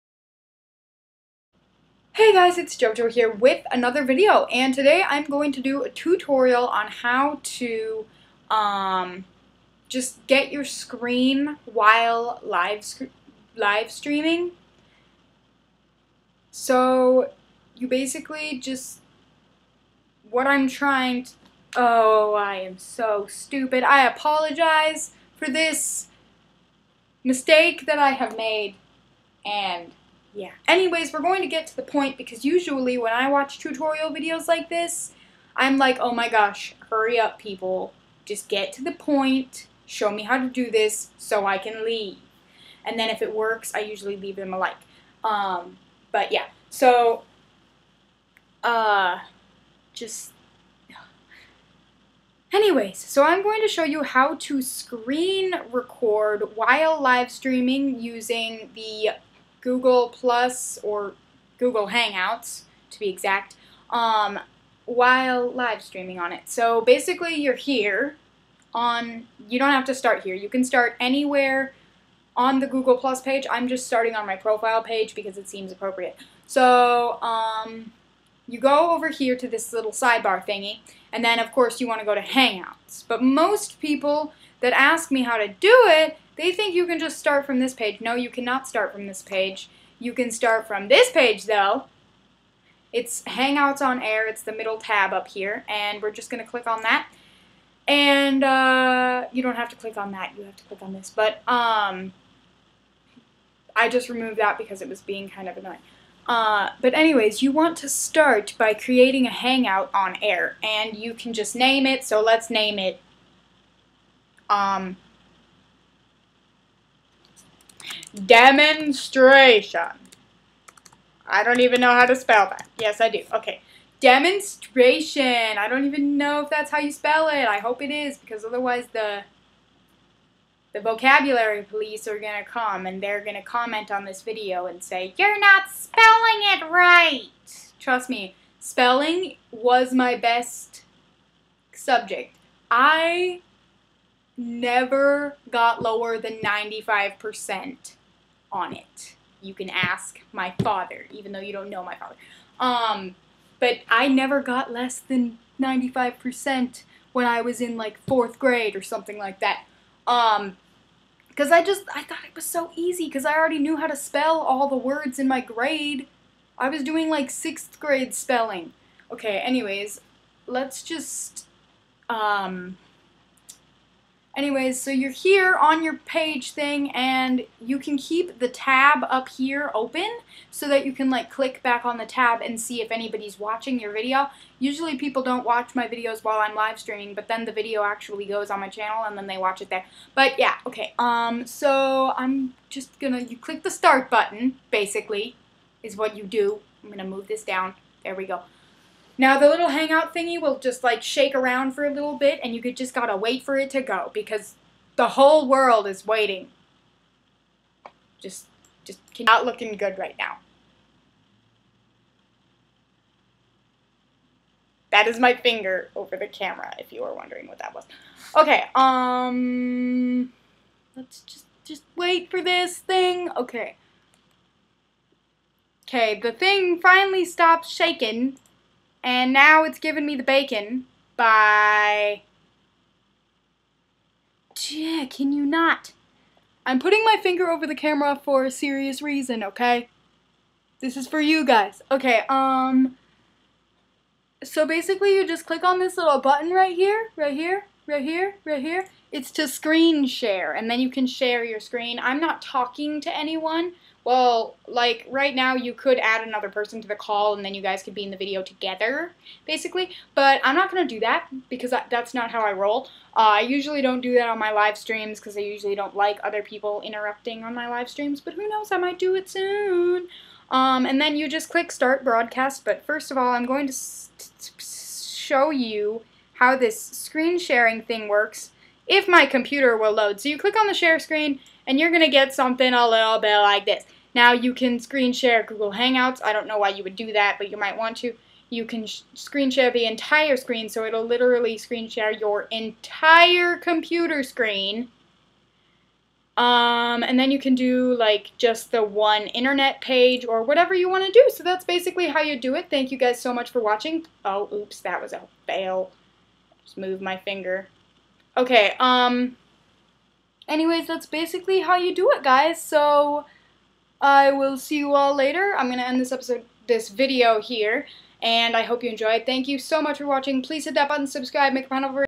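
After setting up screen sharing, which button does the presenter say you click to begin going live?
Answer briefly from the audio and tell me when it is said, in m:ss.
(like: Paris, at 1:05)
Start broadcast, at 4:31.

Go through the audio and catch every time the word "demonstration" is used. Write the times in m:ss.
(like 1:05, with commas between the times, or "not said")
1:58, 2:04.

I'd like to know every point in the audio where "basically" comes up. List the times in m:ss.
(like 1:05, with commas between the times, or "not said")
0:17, 1:06, 3:14, 4:04, 4:19, 5:01, 5:11.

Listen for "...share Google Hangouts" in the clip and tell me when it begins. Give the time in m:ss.
4:45.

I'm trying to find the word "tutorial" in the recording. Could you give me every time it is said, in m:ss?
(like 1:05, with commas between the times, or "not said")
0:05, 0:33.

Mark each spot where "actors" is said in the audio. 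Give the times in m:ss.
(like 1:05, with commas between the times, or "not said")
not said.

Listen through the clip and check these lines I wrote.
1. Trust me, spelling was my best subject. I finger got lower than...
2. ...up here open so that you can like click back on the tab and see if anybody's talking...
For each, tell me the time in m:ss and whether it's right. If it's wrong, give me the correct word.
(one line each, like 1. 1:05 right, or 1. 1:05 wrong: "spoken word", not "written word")
1. 2:17 wrong: "never", not "finger"
2. 2:59 wrong: "watching", not "talking".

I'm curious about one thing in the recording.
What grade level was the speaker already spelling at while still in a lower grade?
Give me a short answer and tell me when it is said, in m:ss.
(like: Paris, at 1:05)
Sixth grade, at 2:47.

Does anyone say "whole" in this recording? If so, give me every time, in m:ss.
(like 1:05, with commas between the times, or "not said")
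3:25.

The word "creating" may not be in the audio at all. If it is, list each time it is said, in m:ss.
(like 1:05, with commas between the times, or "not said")
1:48.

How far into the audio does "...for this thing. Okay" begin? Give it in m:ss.
3:42.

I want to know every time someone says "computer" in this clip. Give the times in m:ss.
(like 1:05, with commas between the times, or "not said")
4:39, 4:53.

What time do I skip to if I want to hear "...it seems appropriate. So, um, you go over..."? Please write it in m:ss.
1:15.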